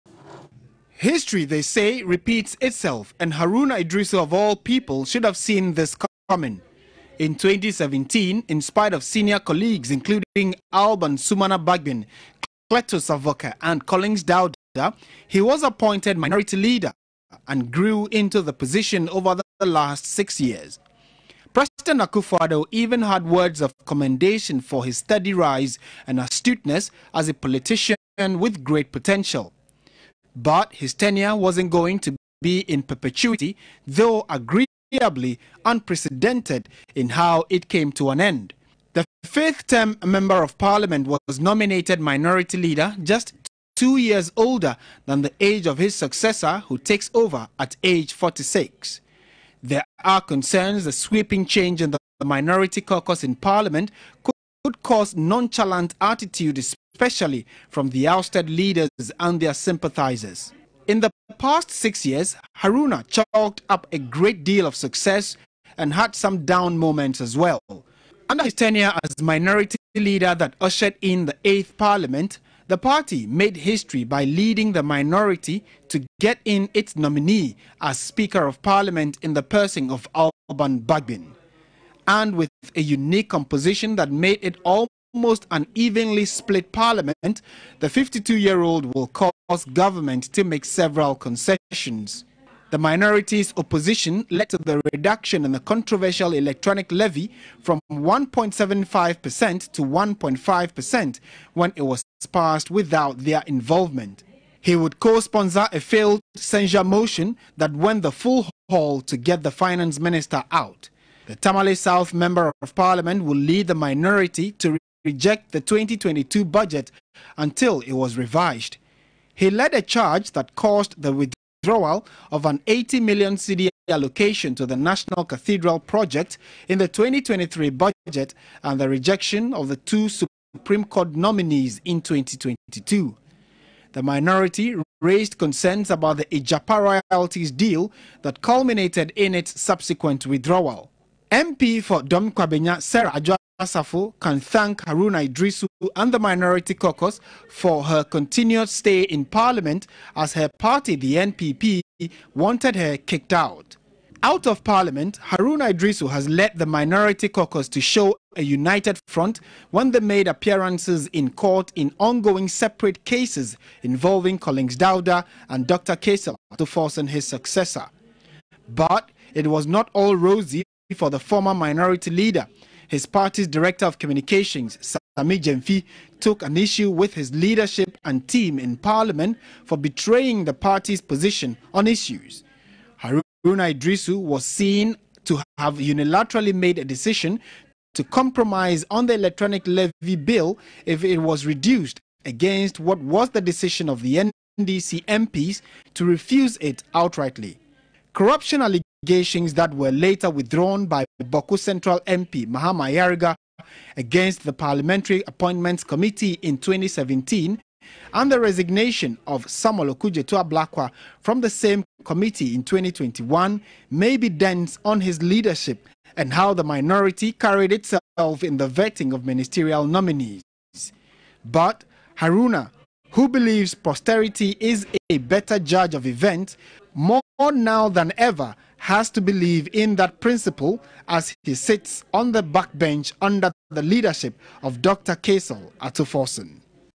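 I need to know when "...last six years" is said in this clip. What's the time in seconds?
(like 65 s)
19 s.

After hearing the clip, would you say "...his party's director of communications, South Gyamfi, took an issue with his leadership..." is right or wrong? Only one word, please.
wrong.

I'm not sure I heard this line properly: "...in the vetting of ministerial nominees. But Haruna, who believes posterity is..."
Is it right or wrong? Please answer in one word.
right.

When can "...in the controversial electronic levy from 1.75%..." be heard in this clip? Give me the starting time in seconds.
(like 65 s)
95 s.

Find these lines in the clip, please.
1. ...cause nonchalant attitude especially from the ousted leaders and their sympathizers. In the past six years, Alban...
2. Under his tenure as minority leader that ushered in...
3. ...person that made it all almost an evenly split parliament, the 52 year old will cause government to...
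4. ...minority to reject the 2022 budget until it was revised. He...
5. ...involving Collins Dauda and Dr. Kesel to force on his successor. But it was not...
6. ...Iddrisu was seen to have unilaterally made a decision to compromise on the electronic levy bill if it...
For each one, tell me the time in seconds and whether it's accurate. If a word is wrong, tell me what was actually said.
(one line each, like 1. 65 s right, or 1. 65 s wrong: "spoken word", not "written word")
1. 54 s wrong: "Haruna", not "Alban"
2. 68 s right
3. 83 s wrong: "composition", not "person"
4. 113 s right
5. 163 s right
6. 183 s right.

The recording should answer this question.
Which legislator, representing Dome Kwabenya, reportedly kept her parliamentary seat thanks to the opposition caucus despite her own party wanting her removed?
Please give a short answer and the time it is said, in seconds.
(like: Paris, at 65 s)
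Sarah Asafo, at 142 s.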